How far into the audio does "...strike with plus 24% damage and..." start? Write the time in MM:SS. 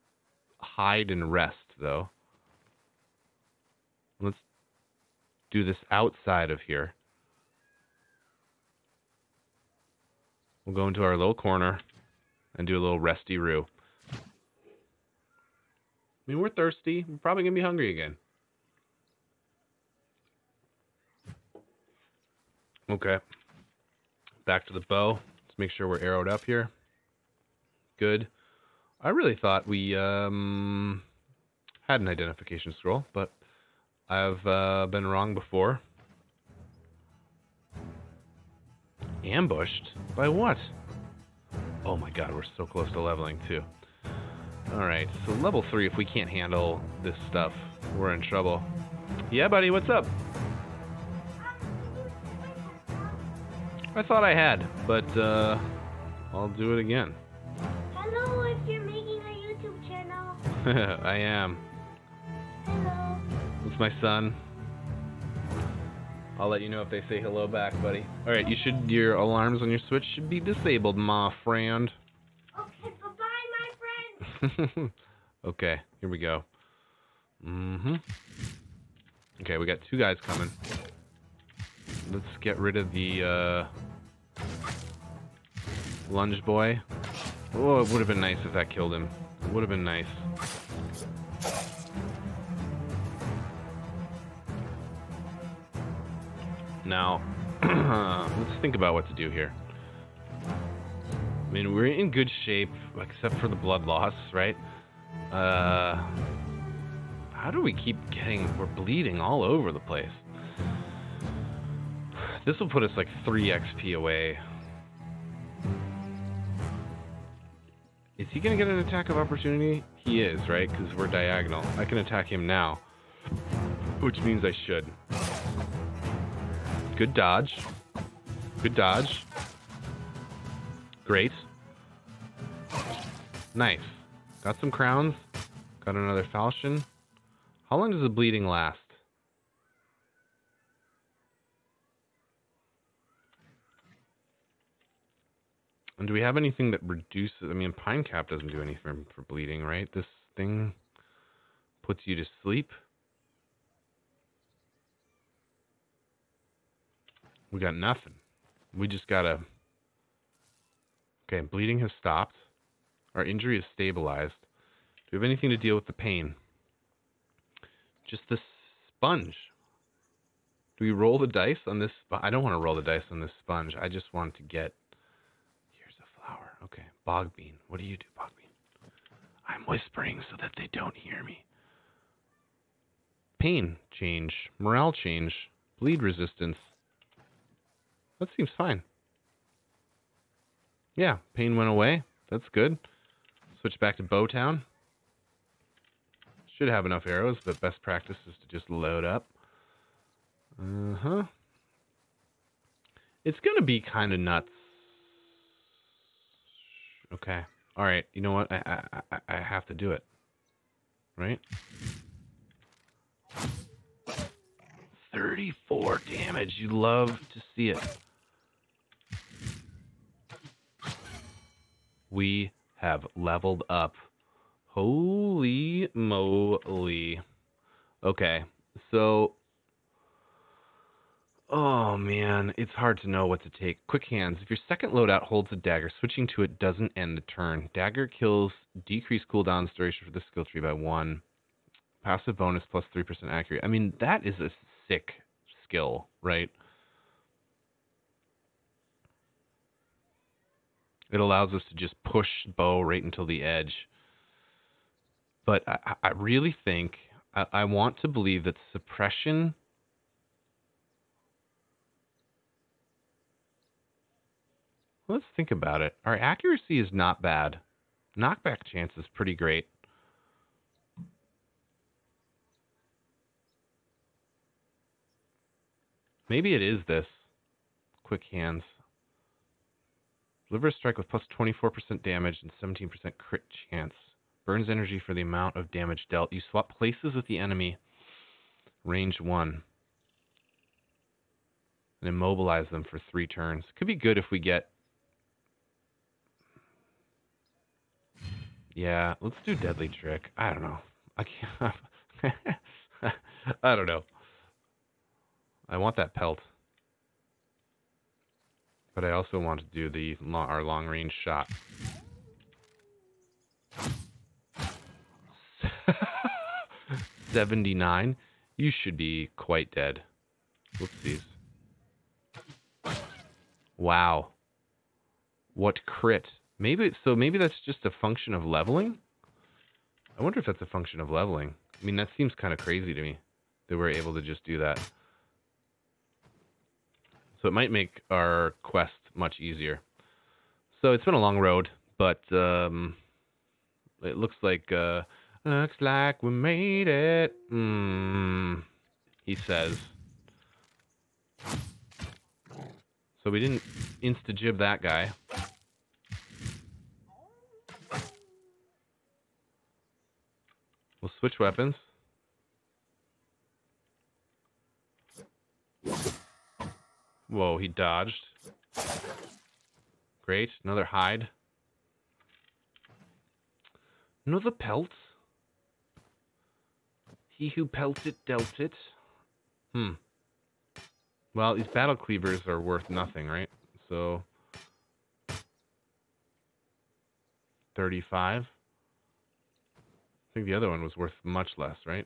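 04:40.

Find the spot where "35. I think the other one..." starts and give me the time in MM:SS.
06:27.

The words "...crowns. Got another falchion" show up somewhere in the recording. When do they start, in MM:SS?
02:14.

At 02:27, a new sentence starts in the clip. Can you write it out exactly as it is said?
I mean, pine cap doesn't do anything for bleeding, right?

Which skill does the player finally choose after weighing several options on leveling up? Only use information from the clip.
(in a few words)
Deadly Trick.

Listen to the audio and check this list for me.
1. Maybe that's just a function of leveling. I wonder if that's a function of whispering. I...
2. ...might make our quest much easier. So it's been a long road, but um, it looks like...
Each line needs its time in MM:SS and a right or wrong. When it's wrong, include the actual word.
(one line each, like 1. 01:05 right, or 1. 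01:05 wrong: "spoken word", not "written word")
1. 05:27 wrong: "leveling", not "whispering"
2. 05:37 right.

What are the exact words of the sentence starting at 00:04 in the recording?
Let's do this outside of here.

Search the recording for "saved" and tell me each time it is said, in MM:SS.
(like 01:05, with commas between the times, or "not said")
not said.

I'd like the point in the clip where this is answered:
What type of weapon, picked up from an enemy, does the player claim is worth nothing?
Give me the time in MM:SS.
06:21.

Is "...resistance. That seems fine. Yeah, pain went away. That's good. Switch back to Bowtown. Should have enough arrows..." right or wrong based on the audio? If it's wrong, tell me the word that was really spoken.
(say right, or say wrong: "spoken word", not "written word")
right.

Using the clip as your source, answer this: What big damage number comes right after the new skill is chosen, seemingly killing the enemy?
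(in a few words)
79.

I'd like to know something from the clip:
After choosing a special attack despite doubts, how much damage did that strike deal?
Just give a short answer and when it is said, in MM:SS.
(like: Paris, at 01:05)
34, at 03:35.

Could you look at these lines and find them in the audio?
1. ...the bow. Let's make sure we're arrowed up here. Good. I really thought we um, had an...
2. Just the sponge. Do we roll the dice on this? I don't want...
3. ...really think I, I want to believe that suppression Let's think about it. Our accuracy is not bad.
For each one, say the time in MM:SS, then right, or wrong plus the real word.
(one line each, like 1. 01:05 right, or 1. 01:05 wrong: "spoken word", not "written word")
1. 00:24 right
2. 02:48 right
3. 04:16 right.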